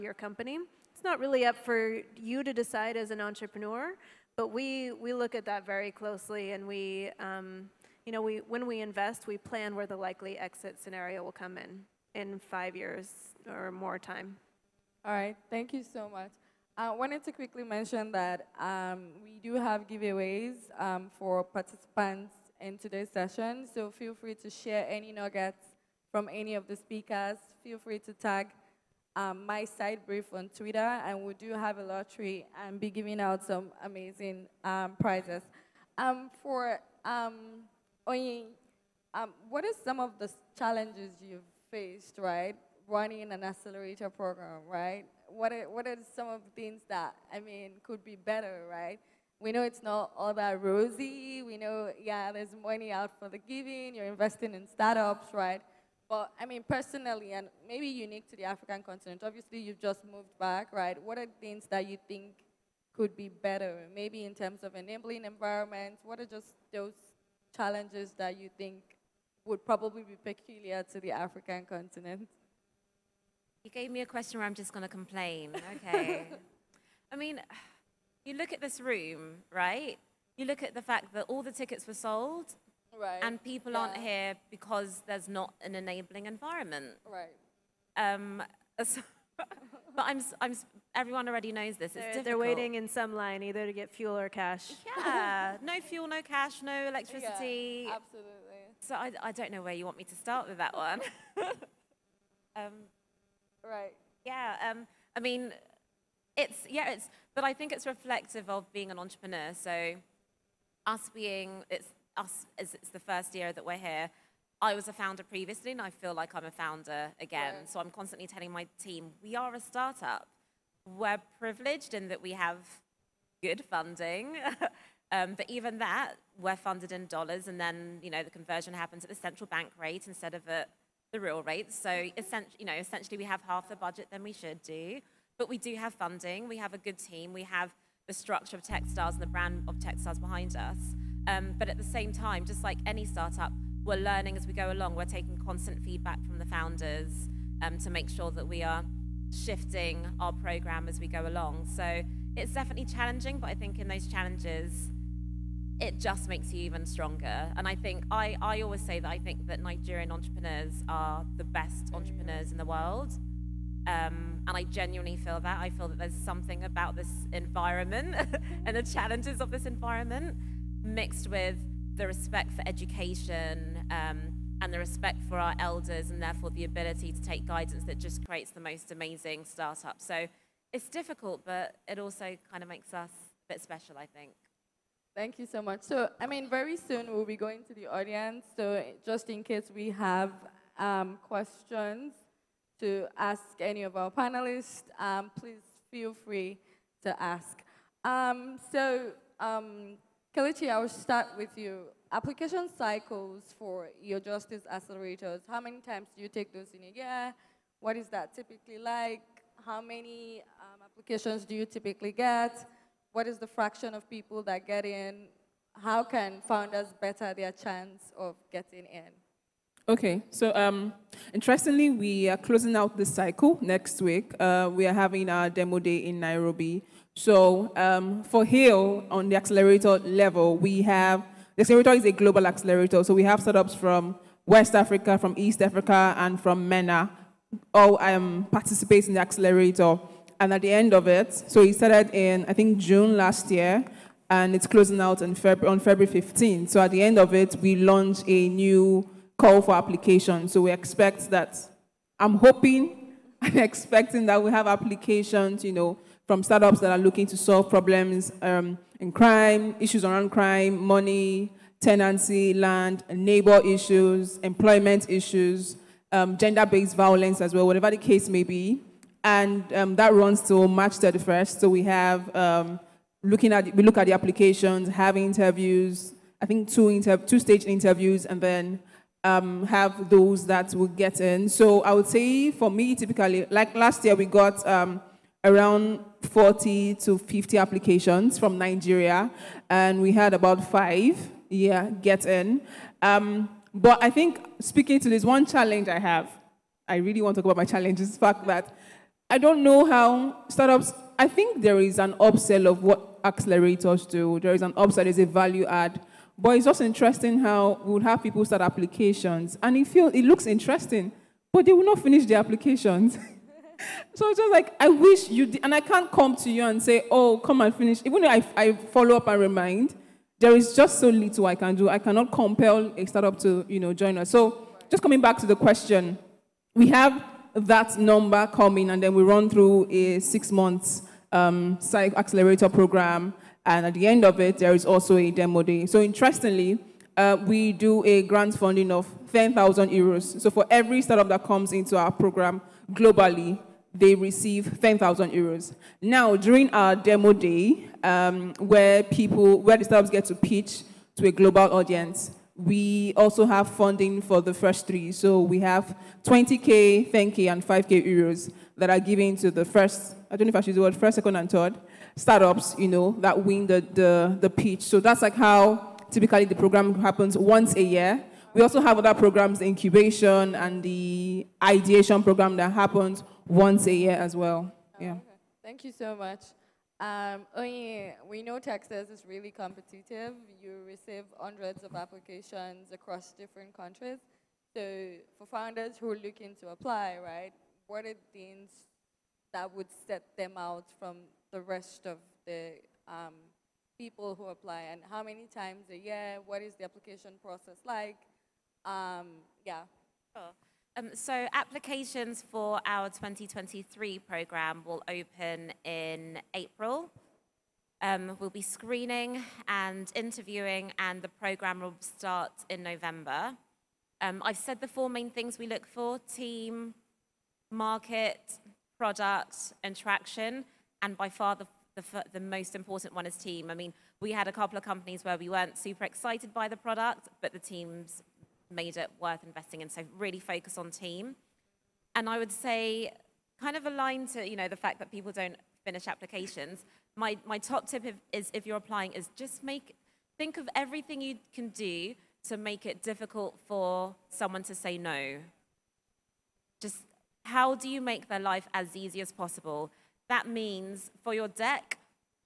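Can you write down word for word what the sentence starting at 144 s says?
We're taking constant feedback from the founders um, to make sure that we are shifting our program as we go along.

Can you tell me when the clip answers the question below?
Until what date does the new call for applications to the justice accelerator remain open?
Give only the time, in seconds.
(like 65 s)
270 s.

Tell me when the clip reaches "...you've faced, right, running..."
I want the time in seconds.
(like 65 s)
41 s.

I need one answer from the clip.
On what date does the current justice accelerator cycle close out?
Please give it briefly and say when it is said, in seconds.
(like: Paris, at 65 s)
February 15, at 245 s.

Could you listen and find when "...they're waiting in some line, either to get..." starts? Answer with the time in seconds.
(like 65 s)
92 s.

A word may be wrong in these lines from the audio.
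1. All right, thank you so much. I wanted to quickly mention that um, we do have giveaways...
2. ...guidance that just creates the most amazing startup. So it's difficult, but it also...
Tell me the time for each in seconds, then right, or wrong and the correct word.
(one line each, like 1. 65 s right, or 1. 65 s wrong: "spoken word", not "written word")
1. 15 s right
2. 177 s right.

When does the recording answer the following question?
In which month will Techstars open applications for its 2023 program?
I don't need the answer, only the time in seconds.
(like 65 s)
406 s.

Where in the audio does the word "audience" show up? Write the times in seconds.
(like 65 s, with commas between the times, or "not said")
187 s, 351 s.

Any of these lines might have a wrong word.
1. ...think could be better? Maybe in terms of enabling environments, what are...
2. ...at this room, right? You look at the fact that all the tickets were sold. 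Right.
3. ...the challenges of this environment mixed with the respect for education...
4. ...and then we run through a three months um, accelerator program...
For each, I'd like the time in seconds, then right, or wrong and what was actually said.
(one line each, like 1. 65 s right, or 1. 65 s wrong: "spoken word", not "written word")
1. 62 s right
2. 78 s right
3. 168 s right
4. 328 s wrong: "six", not "three".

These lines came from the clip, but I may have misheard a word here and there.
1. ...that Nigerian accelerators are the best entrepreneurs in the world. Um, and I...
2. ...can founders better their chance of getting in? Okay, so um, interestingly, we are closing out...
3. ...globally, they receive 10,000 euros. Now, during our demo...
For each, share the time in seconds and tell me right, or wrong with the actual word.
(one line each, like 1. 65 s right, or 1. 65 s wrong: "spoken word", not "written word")
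1. 159 s wrong: "entrepreneurs", not "accelerators"
2. 216 s right
3. 342 s right.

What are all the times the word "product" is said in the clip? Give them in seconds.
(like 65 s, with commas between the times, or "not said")
418 s, 426 s.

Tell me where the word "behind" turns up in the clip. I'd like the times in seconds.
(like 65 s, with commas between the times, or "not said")
140 s.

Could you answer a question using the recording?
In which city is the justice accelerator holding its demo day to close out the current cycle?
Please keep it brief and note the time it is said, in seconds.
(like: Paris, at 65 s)
Nairobi, at 226 s.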